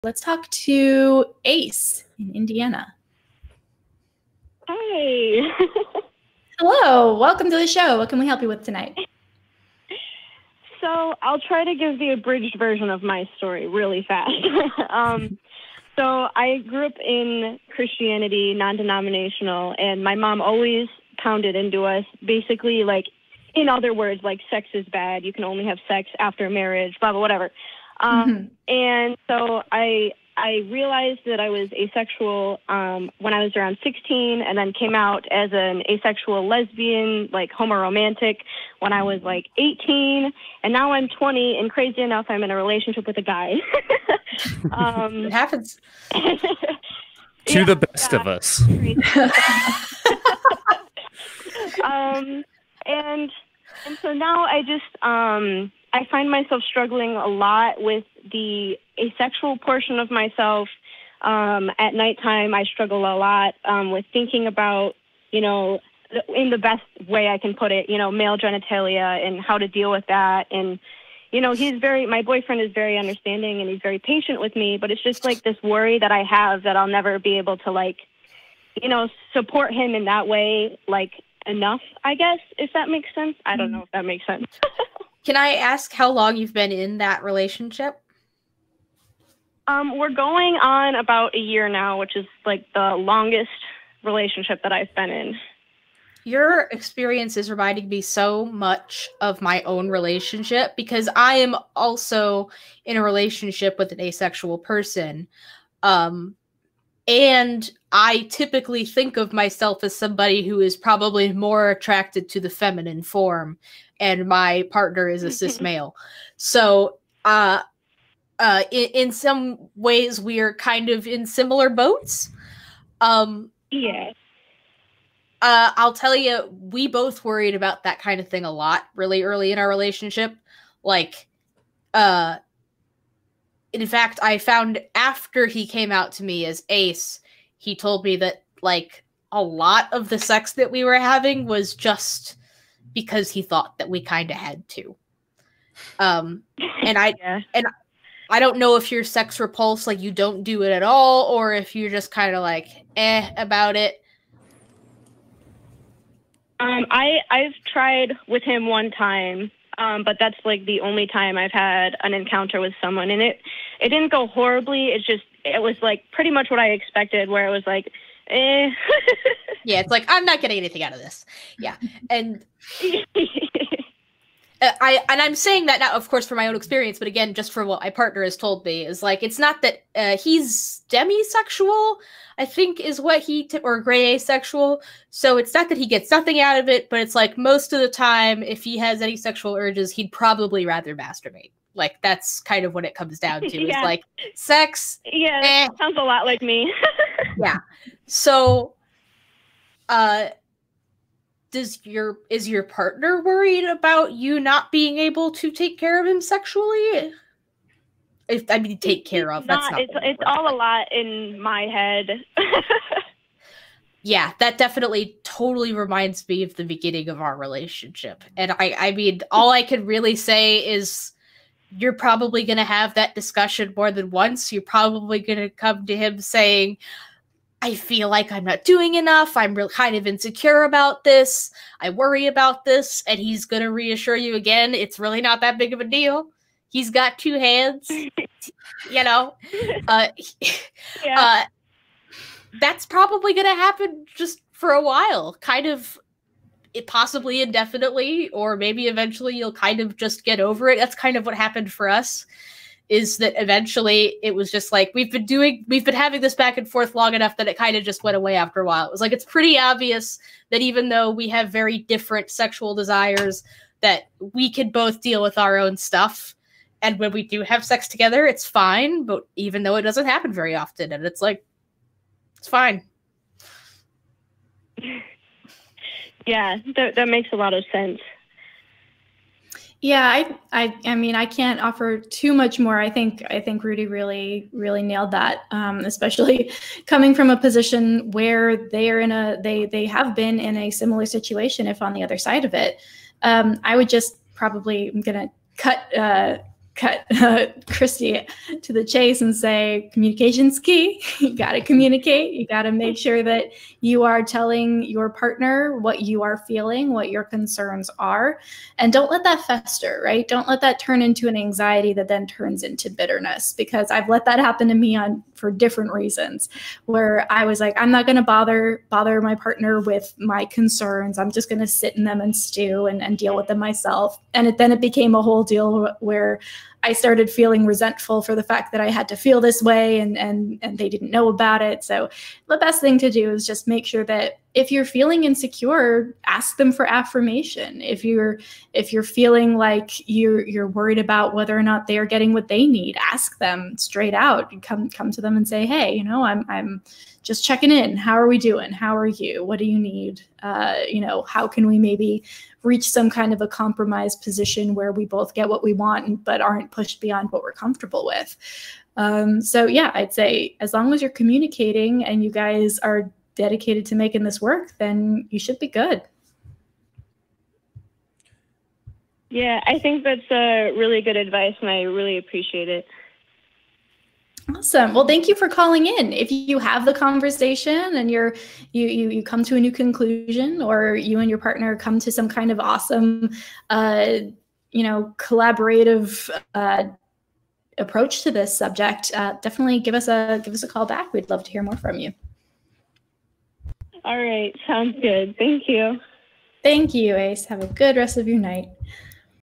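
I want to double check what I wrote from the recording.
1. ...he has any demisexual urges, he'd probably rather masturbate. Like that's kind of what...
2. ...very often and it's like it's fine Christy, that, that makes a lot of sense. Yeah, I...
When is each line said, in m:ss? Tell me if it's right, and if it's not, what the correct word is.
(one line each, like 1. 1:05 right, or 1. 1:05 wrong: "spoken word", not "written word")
1. 3:08 wrong: "sexual", not "demisexual"
2. 4:30 wrong: "Yeah", not "Christy".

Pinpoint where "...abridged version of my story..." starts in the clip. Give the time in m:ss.
0:12.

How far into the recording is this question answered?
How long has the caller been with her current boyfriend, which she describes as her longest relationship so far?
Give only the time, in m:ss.
1:31.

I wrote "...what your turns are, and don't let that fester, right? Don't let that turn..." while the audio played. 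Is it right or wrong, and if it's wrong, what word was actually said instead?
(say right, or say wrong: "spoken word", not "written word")
wrong: "concerns", not "turns".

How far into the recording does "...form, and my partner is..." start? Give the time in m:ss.
1:53.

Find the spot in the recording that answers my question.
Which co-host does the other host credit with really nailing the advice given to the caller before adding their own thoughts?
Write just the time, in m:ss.
4:43.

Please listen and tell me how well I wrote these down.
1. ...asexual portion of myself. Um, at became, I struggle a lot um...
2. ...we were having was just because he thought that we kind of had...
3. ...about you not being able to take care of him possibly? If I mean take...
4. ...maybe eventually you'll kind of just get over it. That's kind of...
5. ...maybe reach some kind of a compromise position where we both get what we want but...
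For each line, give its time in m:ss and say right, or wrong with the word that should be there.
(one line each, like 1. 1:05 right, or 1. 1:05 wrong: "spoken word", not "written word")
1. 0:58 wrong: "nighttime", not "became"
2. 2:20 right
3. 3:23 wrong: "sexually", not "possibly"
4. 4:08 right
5. 5:51 right.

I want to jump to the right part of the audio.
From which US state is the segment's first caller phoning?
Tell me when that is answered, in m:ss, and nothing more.
0:02.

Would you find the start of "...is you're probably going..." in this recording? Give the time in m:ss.
3:40.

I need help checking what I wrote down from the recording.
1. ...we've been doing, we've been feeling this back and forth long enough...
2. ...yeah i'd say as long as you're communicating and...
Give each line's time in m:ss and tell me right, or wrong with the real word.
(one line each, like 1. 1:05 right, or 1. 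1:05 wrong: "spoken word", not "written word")
1. 4:14 wrong: "having", not "feeling"
2. 5:59 right.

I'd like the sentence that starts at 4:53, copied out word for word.
Um, I would just probably, I'm gonna cut, uh, cut uh, Christy to the chase and say communication's key.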